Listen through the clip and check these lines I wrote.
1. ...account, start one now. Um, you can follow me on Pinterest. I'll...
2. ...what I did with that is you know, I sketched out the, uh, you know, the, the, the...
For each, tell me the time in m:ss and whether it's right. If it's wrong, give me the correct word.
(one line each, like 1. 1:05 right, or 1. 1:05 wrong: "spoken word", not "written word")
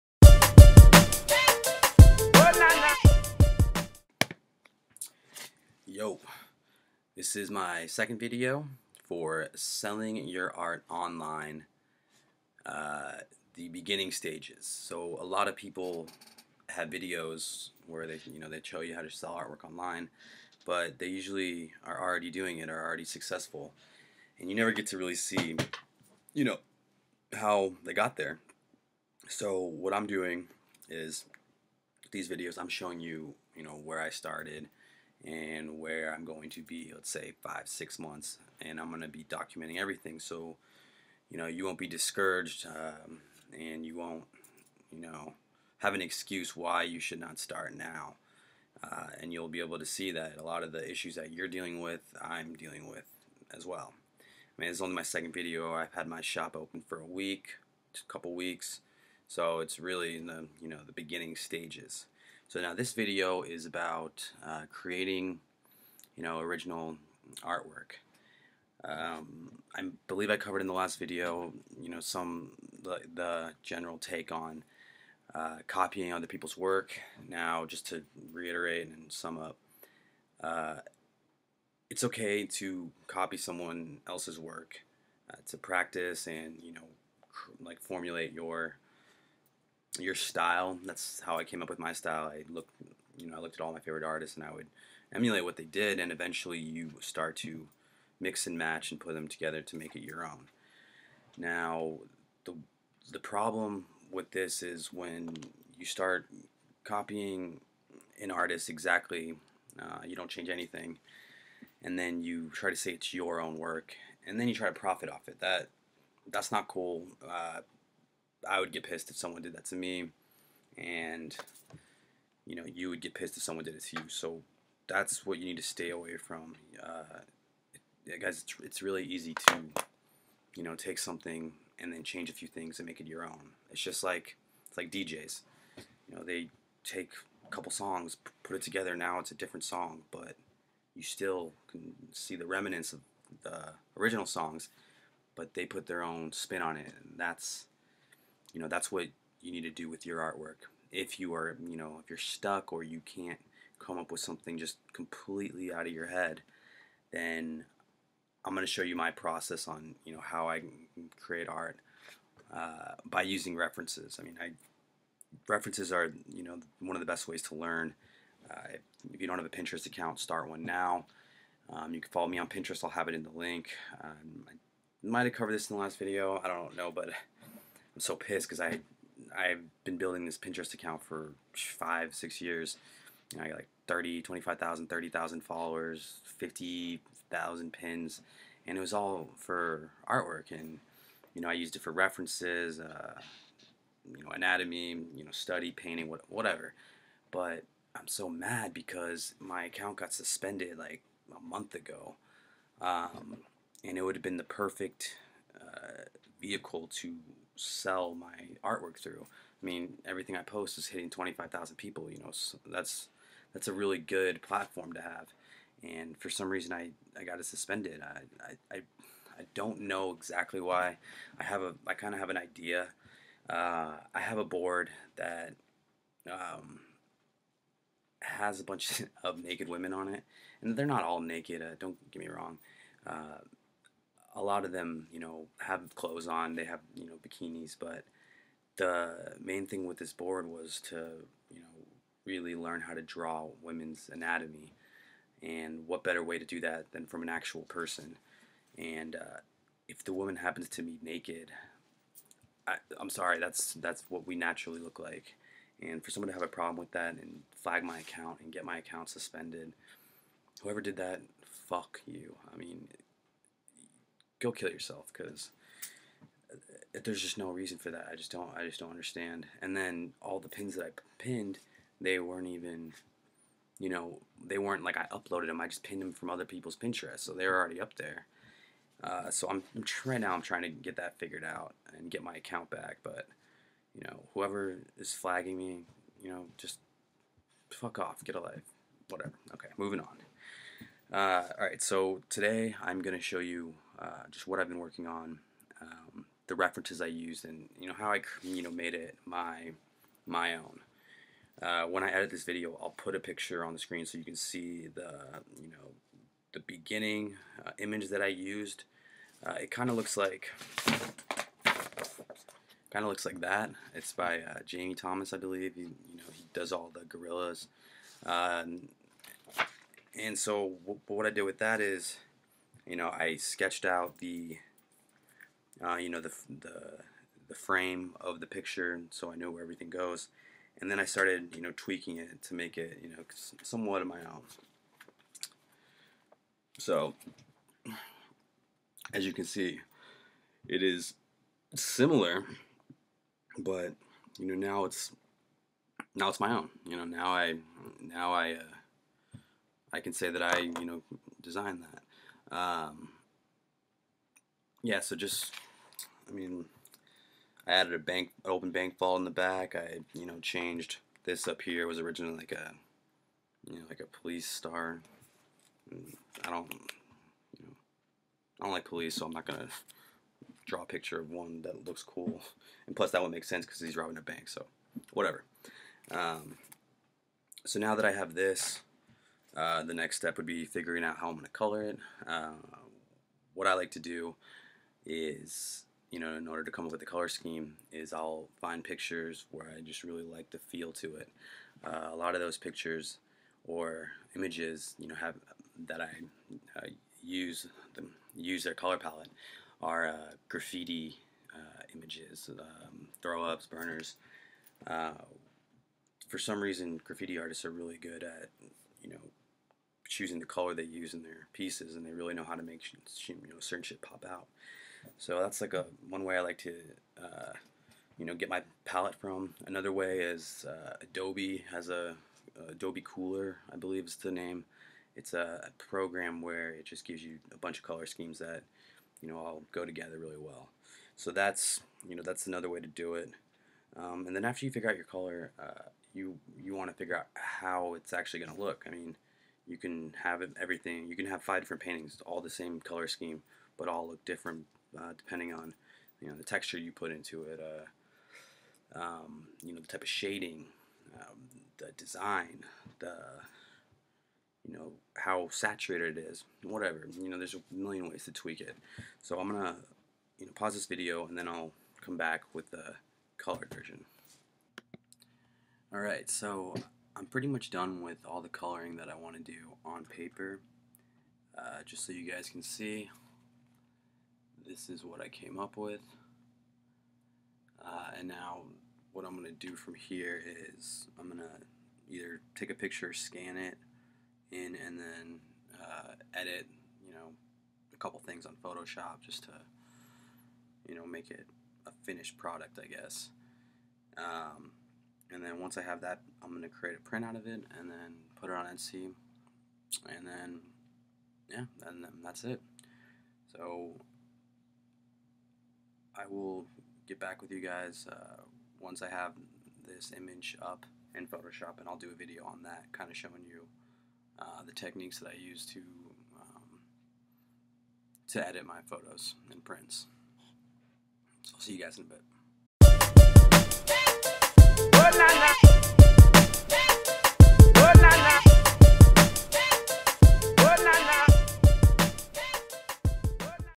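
1. 2:49 right
2. 5:21 right.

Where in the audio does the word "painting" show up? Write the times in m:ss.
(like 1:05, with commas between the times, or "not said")
3:15, 7:21.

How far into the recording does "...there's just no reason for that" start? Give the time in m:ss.
4:27.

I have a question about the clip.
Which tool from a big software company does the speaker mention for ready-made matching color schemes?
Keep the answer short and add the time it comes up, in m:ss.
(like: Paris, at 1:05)
Adobe Kuler, at 7:02.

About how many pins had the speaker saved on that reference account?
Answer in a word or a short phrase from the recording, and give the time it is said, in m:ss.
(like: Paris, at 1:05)
50,000, at 3:06.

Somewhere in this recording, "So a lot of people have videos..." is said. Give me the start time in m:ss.
0:14.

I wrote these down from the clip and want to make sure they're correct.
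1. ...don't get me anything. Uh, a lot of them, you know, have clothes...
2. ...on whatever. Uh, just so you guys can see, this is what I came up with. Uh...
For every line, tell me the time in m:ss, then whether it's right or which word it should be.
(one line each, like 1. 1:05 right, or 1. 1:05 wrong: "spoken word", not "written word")
1. 3:51 wrong: "wrong", not "anything"
2. 7:49 wrong: "paper", not "whatever".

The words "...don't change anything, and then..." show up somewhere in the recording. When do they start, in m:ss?
1:50.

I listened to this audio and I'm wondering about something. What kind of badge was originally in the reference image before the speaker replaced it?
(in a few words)
A police star.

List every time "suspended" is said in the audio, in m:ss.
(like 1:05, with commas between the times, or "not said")
3:20, 3:37, 4:19.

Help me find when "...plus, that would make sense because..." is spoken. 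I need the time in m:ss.
6:12.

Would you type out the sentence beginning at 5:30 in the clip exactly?
And then I started, you know, tweaking it to make it, you know, somewhat of my own.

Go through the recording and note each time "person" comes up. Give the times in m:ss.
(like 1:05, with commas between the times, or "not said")
4:07.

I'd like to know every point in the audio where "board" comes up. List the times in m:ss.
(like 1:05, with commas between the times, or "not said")
3:44, 4:00.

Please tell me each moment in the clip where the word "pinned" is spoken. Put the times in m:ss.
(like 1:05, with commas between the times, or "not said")
4:31, 4:35.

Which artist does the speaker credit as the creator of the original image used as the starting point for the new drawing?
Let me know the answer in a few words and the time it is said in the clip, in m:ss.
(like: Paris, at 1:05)
Jamie Thomas, at 5:14.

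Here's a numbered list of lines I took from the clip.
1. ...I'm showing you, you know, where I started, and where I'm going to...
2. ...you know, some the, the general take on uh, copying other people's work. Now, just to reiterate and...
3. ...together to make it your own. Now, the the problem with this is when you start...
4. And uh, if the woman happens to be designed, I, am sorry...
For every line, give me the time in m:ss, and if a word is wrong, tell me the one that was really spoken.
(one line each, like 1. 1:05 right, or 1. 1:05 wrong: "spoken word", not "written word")
1. 0:32 right
2. 1:11 right
3. 1:39 right
4. 4:08 wrong: "naked", not "designed".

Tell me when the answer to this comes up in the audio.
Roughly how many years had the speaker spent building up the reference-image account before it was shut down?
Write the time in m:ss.
3:01.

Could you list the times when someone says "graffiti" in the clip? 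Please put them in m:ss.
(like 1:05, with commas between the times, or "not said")
6:40, 6:47.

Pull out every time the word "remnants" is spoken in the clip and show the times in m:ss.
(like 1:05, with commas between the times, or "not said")
2:22.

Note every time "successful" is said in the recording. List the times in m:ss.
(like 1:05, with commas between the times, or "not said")
0:23.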